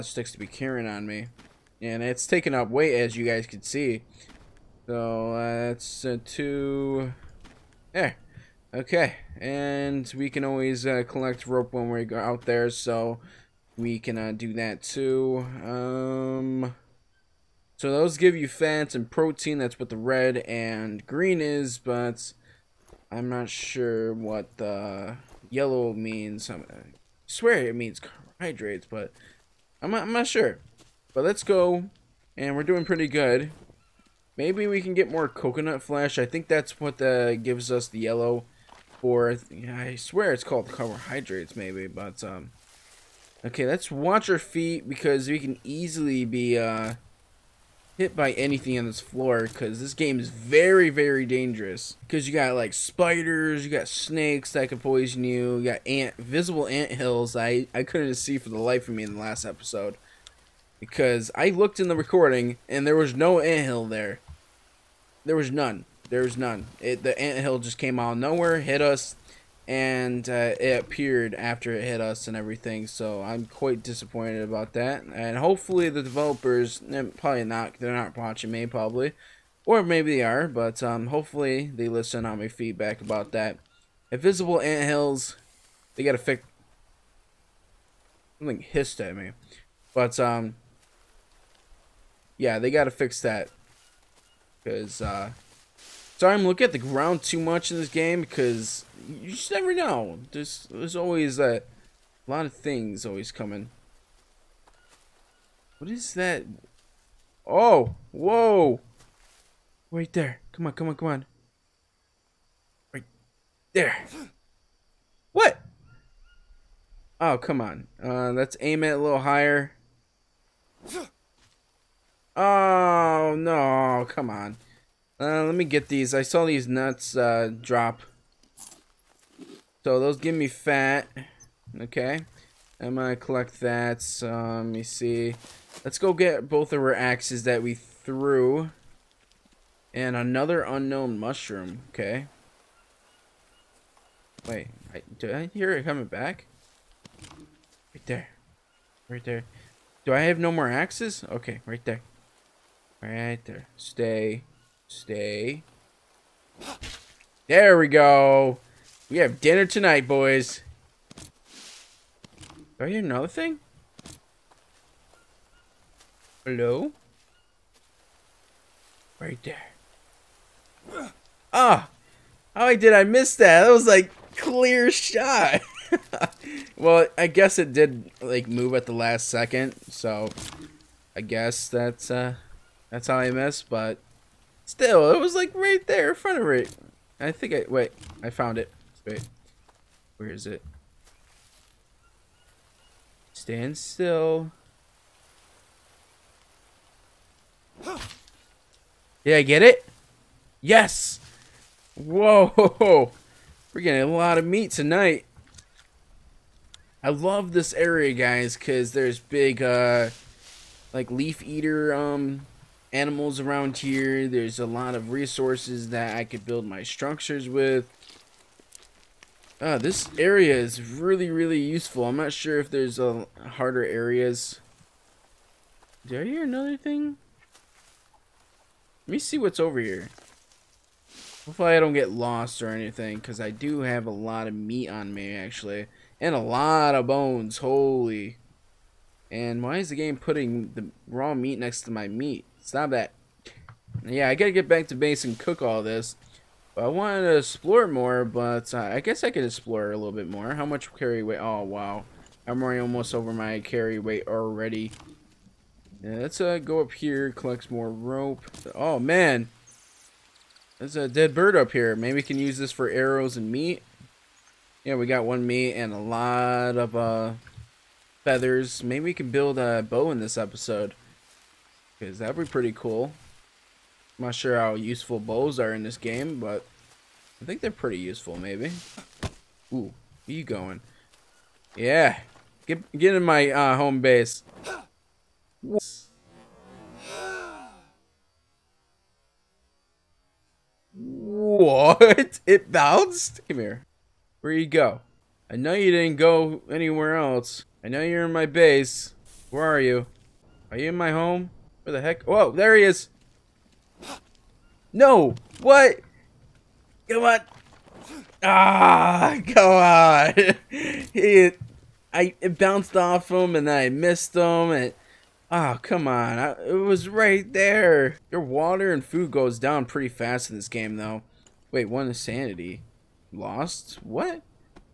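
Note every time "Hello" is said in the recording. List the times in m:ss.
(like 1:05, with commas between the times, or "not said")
2:46.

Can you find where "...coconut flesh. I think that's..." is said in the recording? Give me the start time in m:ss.
0:35.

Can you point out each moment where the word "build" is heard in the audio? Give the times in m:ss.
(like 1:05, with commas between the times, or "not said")
3:36, 4:29.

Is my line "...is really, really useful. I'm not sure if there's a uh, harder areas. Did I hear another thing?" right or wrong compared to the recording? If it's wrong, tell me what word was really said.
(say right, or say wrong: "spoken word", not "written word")
right.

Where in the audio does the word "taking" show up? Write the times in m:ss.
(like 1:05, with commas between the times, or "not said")
0:02.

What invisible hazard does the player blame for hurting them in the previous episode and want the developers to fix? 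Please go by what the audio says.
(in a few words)
anthills.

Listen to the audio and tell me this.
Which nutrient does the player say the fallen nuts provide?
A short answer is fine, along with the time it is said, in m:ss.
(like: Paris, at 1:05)
fat, at 2:09.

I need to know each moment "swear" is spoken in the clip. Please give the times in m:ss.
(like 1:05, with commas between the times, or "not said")
0:27, 0:39.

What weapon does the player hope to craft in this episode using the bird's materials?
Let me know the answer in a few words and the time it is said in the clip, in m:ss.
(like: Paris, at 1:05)
a bow, at 4:29.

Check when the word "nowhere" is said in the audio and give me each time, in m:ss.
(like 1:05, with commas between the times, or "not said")
1:08.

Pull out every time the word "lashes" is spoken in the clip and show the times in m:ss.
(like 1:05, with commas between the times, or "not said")
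not said.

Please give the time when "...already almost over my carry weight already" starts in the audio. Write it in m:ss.
4:12.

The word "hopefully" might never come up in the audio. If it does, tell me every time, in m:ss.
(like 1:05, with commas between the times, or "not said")
1:15, 1:21, 3:51.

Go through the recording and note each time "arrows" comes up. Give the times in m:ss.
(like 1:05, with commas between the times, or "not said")
4:22.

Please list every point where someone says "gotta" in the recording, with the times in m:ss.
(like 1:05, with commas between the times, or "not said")
1:26, 1:32, 4:04.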